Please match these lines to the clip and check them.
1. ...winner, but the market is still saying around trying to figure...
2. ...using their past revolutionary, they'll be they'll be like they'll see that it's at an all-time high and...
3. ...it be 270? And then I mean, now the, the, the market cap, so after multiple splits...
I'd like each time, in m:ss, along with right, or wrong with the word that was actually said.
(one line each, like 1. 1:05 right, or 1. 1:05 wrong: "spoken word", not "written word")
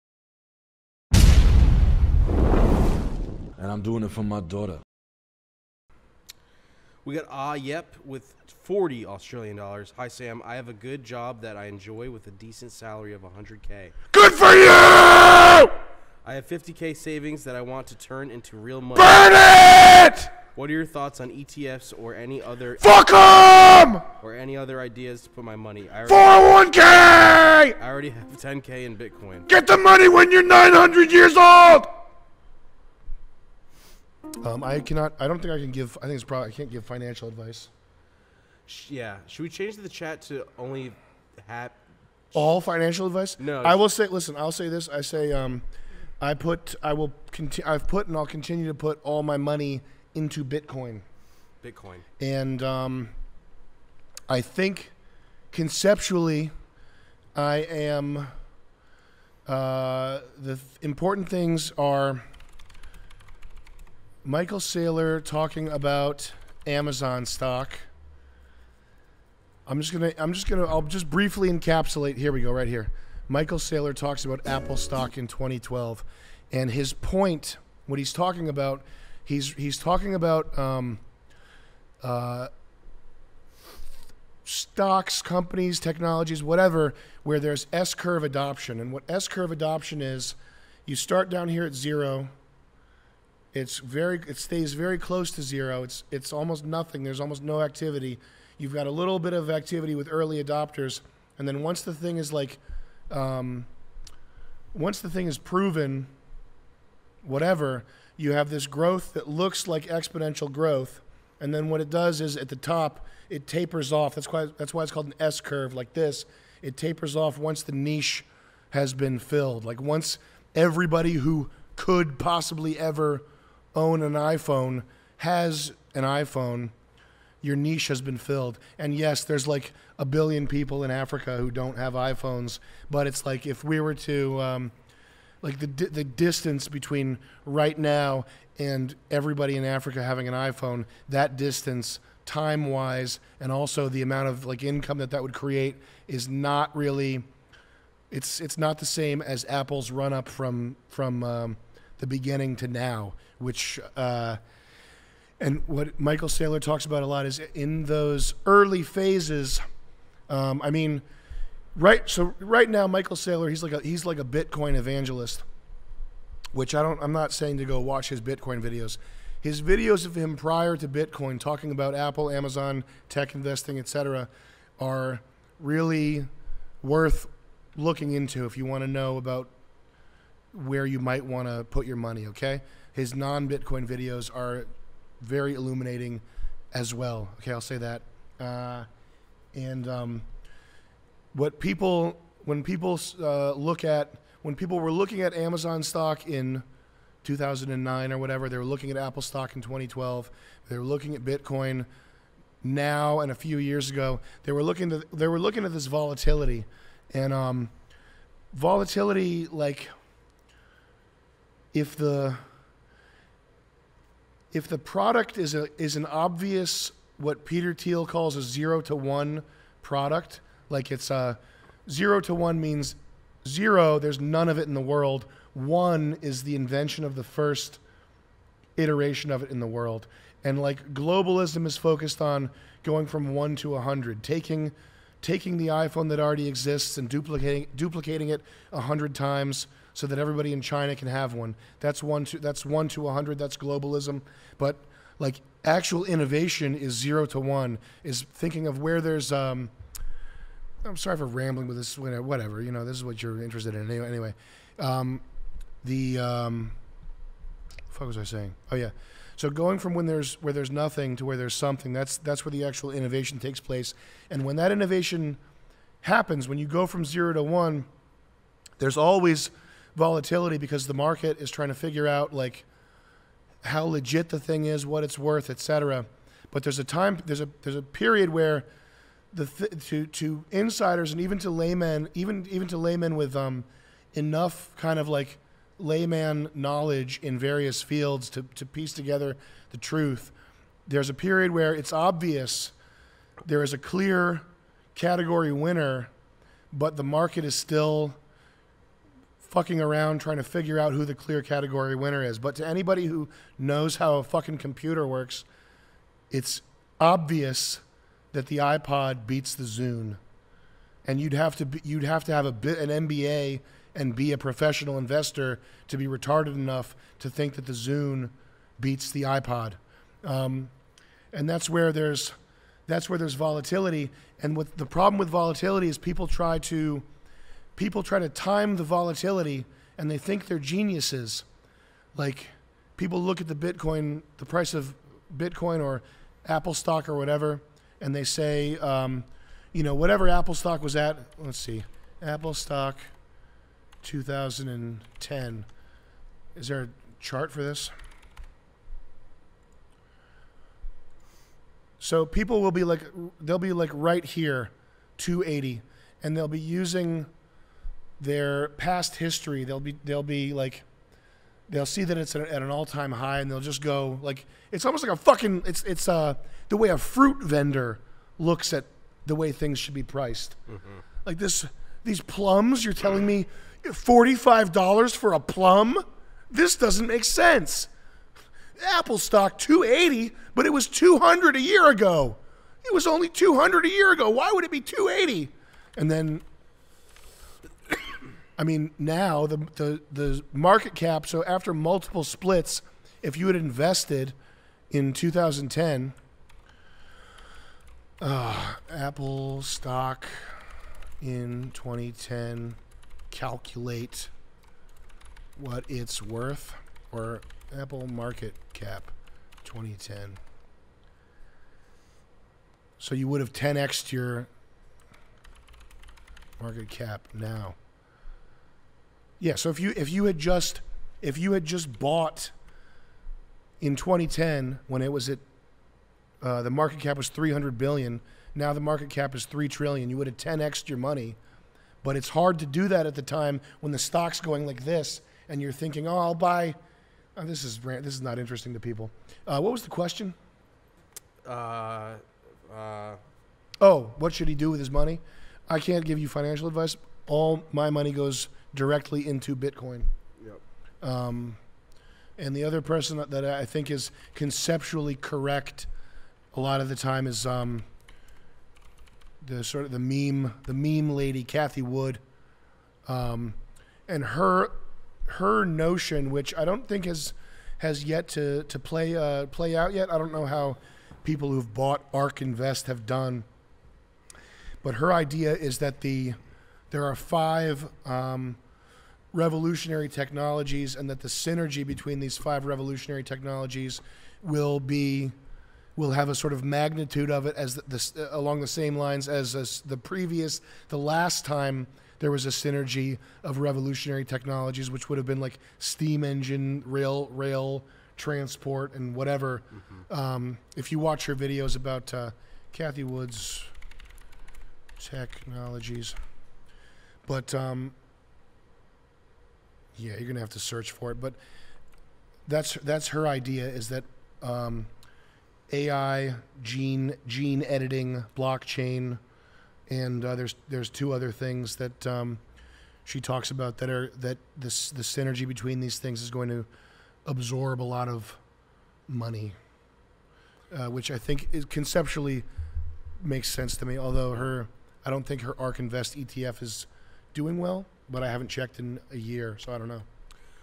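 1. 4:55 wrong: "fucking", not "saying"
2. 5:56 wrong: "history", not "revolutionary"
3. 6:24 wrong: "280", not "270".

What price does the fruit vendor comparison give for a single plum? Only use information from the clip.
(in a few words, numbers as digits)
$45.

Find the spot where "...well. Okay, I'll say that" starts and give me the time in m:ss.
3:06.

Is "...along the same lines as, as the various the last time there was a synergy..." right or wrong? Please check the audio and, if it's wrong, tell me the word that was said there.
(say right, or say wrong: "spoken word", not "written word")
wrong: "previous", not "various".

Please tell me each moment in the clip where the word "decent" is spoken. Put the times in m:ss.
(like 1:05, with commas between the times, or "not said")
0:12.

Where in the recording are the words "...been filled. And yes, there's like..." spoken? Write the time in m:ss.
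2:08.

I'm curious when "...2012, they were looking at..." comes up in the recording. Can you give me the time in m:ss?
3:19.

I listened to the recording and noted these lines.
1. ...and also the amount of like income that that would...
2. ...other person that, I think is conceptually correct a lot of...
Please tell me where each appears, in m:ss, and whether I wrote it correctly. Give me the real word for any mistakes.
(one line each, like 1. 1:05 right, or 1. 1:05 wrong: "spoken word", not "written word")
1. 2:23 right
2. 7:32 right.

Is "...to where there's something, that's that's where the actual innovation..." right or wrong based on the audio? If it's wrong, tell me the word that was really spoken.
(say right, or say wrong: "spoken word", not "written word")
right.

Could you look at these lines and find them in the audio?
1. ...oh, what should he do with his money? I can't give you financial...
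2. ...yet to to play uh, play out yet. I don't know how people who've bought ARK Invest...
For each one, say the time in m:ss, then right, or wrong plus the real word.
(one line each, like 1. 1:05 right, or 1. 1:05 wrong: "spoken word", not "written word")
1. 7:23 right
2. 7:48 right.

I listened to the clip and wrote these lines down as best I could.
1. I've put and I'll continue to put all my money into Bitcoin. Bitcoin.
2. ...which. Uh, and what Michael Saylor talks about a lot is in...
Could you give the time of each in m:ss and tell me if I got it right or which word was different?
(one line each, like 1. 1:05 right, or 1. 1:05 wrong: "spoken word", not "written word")
1. 0:47 right
2. 2:33 right.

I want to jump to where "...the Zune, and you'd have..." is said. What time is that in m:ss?
5:09.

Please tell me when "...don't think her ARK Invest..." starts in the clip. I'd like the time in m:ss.
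8:55.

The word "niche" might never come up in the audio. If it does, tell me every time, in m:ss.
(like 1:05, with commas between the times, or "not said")
1:57, 2:07.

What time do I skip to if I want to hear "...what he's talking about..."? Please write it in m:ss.
1:17.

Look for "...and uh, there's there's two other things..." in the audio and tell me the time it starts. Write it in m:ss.
8:39.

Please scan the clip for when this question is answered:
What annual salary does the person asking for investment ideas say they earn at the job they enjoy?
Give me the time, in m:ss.
0:13.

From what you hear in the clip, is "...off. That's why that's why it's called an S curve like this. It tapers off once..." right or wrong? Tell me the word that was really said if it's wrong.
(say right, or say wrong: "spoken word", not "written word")
right.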